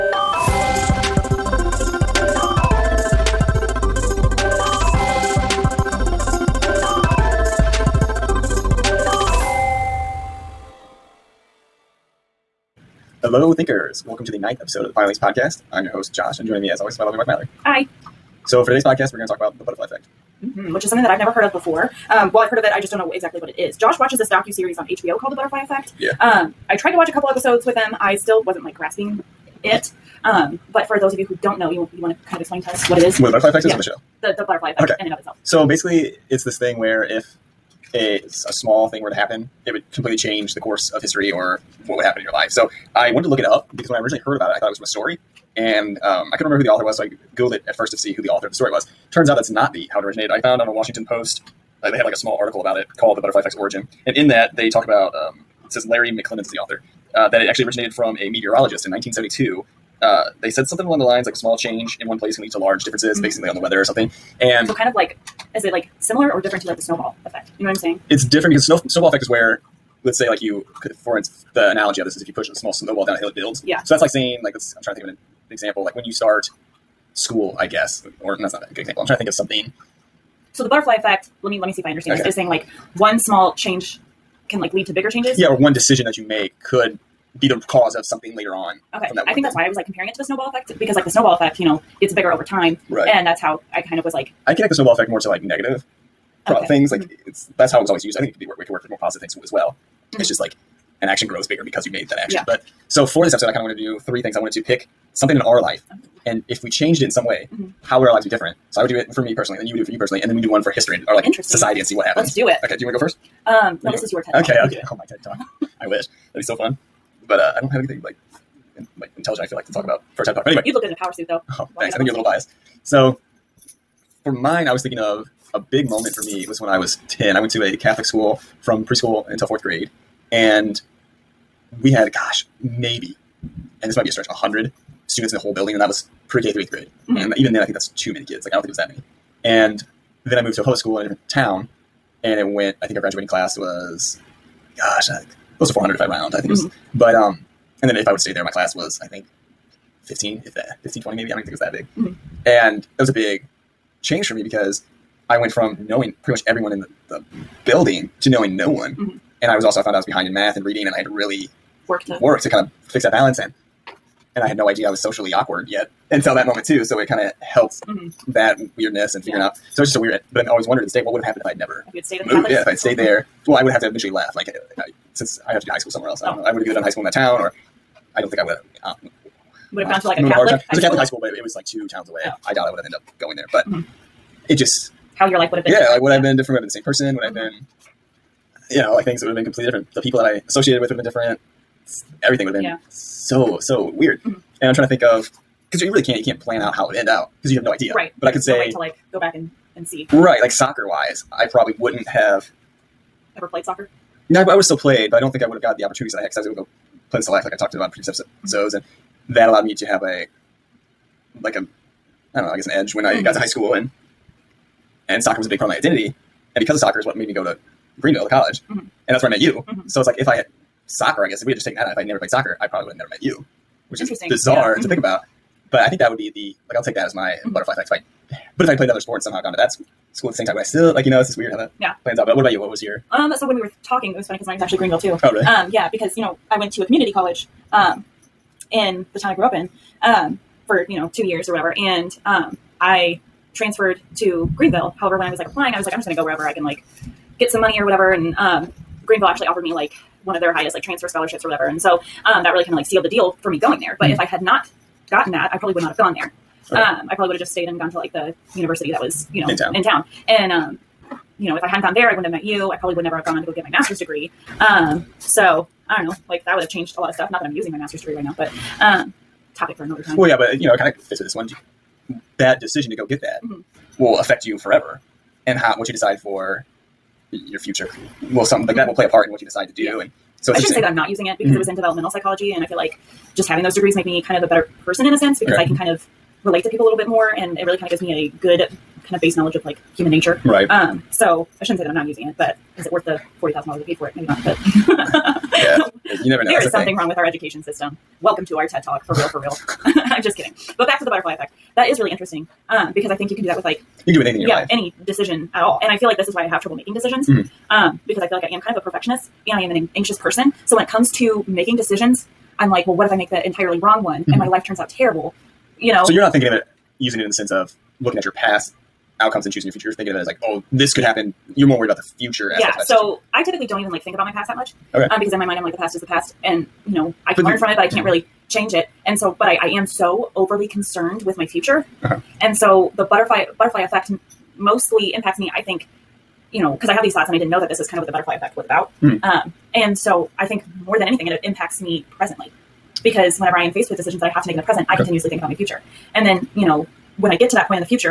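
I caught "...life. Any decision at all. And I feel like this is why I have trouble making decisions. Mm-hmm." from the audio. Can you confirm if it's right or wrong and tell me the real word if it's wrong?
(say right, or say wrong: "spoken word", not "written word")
right.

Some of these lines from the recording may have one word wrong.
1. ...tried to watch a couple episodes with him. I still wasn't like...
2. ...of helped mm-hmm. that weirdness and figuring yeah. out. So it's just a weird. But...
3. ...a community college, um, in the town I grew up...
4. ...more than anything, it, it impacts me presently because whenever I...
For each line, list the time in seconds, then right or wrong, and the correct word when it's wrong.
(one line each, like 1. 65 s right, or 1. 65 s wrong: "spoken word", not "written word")
1. 26 s right
2. 167 s right
3. 236 s right
4. 340 s right.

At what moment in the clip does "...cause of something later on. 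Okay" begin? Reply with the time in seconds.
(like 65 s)
87 s.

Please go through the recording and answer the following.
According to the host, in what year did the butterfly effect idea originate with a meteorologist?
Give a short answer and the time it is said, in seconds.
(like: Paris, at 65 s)
1972, at 58 s.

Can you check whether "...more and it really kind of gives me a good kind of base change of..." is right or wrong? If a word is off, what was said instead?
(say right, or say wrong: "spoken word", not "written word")
wrong: "knowledge", not "change".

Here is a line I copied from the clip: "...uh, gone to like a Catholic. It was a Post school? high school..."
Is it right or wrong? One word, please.
wrong.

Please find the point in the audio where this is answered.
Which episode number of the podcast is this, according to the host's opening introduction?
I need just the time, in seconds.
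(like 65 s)
14 s.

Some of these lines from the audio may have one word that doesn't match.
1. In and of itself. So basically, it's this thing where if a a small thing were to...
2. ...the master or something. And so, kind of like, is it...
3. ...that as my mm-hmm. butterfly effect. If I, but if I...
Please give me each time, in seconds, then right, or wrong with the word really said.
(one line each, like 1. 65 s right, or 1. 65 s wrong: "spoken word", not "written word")
1. 34 s right
2. 63 s wrong: "weather", not "master"
3. 226 s right.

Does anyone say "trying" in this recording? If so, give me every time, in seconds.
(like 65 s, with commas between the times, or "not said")
74 s, 79 s, 194 s.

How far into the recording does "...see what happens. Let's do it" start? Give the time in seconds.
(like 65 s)
111 s.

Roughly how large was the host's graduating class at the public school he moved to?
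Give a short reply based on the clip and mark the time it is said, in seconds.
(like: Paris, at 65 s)
400, at 145 s.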